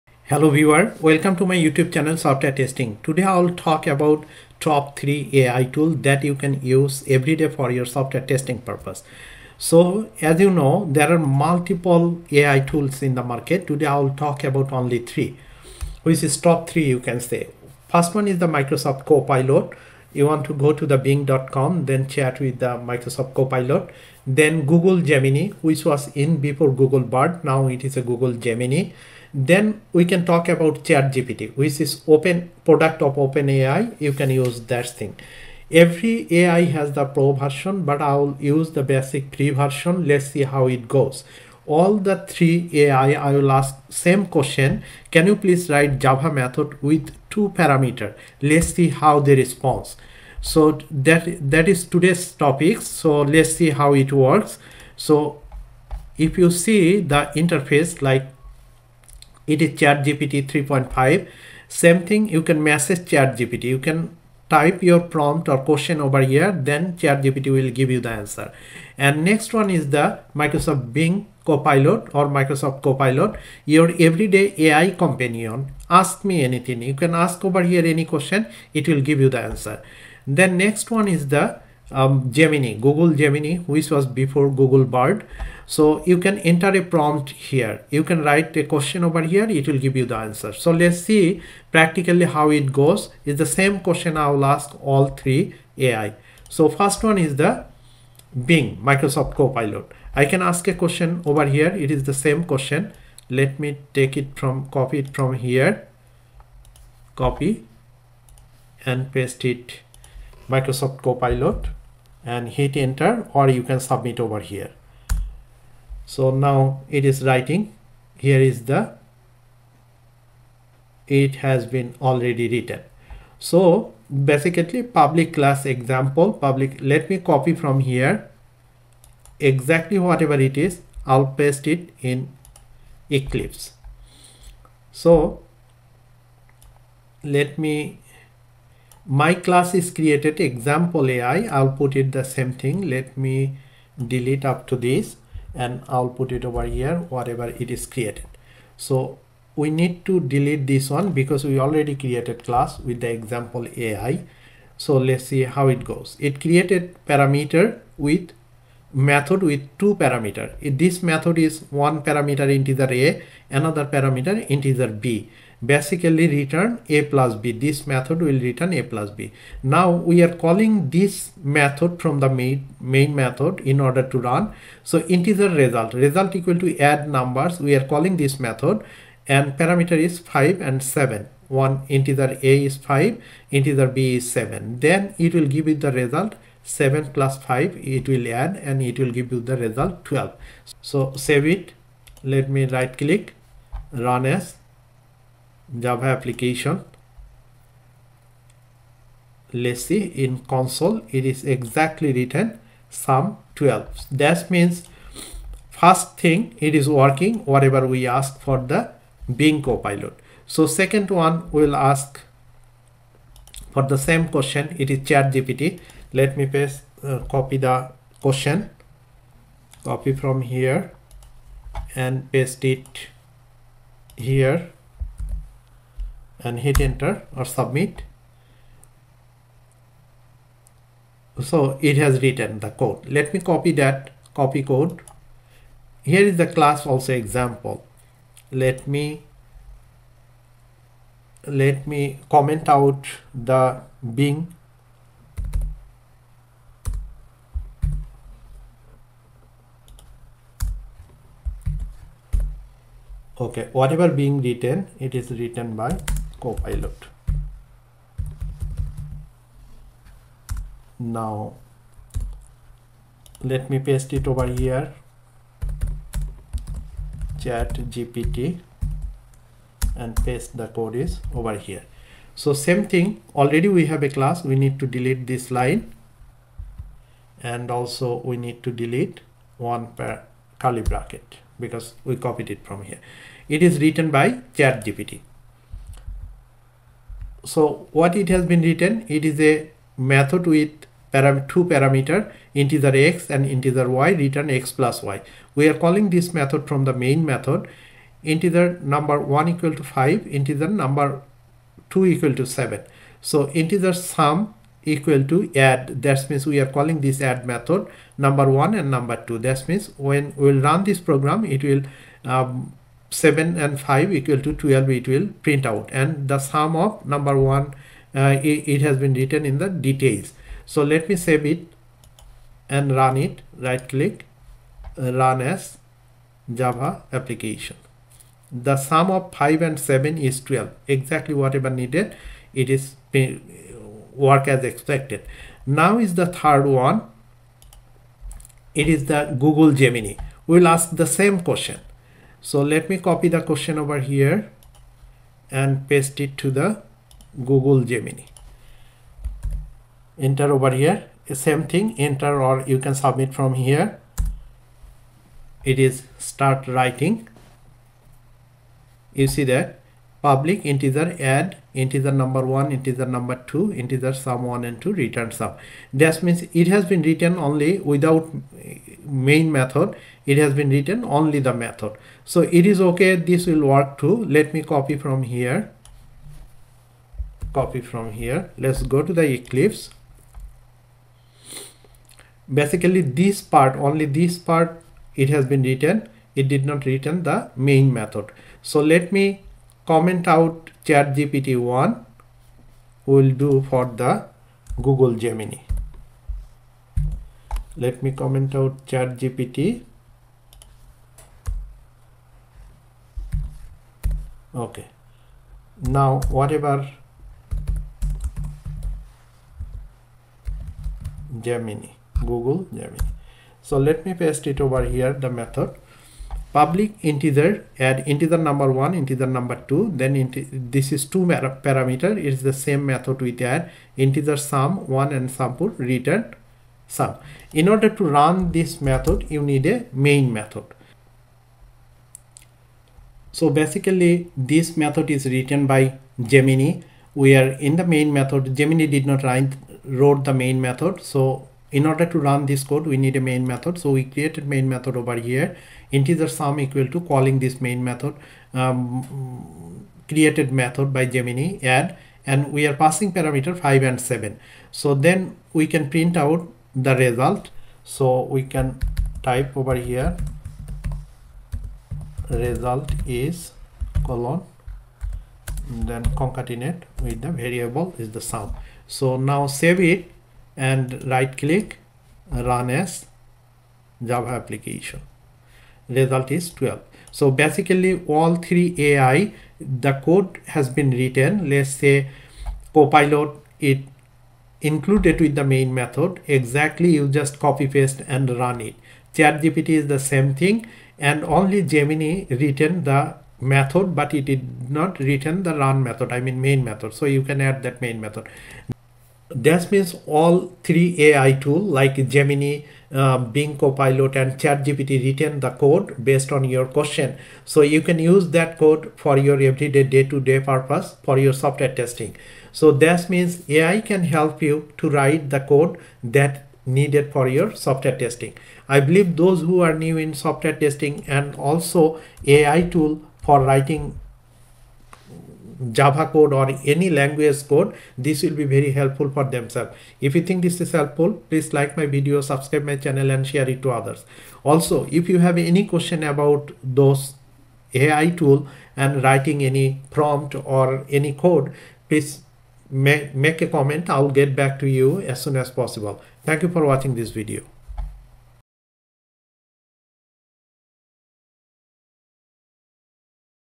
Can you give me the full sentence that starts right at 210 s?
So second one will ask for the same question.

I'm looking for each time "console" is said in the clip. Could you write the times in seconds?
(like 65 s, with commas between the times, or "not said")
200 s.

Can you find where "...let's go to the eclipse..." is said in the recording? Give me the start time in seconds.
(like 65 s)
378 s.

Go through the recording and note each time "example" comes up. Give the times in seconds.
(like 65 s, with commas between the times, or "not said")
125 s, 140 s, 153 s, 237 s.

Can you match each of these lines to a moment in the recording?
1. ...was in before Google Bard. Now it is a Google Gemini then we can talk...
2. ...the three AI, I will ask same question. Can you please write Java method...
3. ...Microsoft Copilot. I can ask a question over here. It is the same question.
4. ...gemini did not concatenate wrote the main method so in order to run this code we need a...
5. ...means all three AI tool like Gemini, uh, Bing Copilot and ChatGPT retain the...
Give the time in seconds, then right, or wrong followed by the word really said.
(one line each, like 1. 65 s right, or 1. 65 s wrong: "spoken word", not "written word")
1. 25 s right
2. 41 s right
3. 98 s right
4. 438 s wrong: "write", not "concatenate"
5. 499 s right.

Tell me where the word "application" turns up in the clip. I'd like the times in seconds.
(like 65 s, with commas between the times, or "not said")
196 s, 327 s, 474 s.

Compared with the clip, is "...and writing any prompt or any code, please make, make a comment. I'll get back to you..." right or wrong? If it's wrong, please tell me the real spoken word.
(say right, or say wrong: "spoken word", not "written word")
right.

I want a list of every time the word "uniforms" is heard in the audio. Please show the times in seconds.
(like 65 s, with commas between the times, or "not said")
not said.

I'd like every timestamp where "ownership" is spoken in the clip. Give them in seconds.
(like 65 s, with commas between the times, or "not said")
not said.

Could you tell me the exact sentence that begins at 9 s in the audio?
So as you know, there are multiple AI tools in the market.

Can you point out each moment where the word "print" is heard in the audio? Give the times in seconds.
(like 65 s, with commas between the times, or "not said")
315 s, 455 s.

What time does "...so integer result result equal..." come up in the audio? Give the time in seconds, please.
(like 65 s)
174 s.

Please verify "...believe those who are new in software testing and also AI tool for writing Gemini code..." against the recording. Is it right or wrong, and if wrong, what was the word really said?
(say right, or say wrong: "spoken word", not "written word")
wrong: "Java", not "Gemini".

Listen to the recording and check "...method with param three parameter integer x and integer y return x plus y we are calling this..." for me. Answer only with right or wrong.
wrong.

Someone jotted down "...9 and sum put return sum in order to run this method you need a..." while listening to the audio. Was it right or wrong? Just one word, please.
wrong.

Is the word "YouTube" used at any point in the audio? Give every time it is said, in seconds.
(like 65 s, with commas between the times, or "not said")
1 s.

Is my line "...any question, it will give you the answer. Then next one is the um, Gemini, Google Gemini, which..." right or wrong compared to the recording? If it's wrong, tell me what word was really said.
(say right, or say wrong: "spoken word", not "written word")
right.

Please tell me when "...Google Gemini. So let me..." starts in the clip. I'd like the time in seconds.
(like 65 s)
412 s.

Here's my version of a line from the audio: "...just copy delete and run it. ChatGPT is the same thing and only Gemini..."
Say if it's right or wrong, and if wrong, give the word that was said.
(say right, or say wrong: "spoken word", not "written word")
wrong: "paste", not "delete".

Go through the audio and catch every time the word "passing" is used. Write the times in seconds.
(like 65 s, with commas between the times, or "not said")
452 s.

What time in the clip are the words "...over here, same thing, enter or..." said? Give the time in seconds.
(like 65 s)
350 s.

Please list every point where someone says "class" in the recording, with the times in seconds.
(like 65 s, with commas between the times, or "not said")
125 s, 139 s, 152 s, 236 s, 274 s.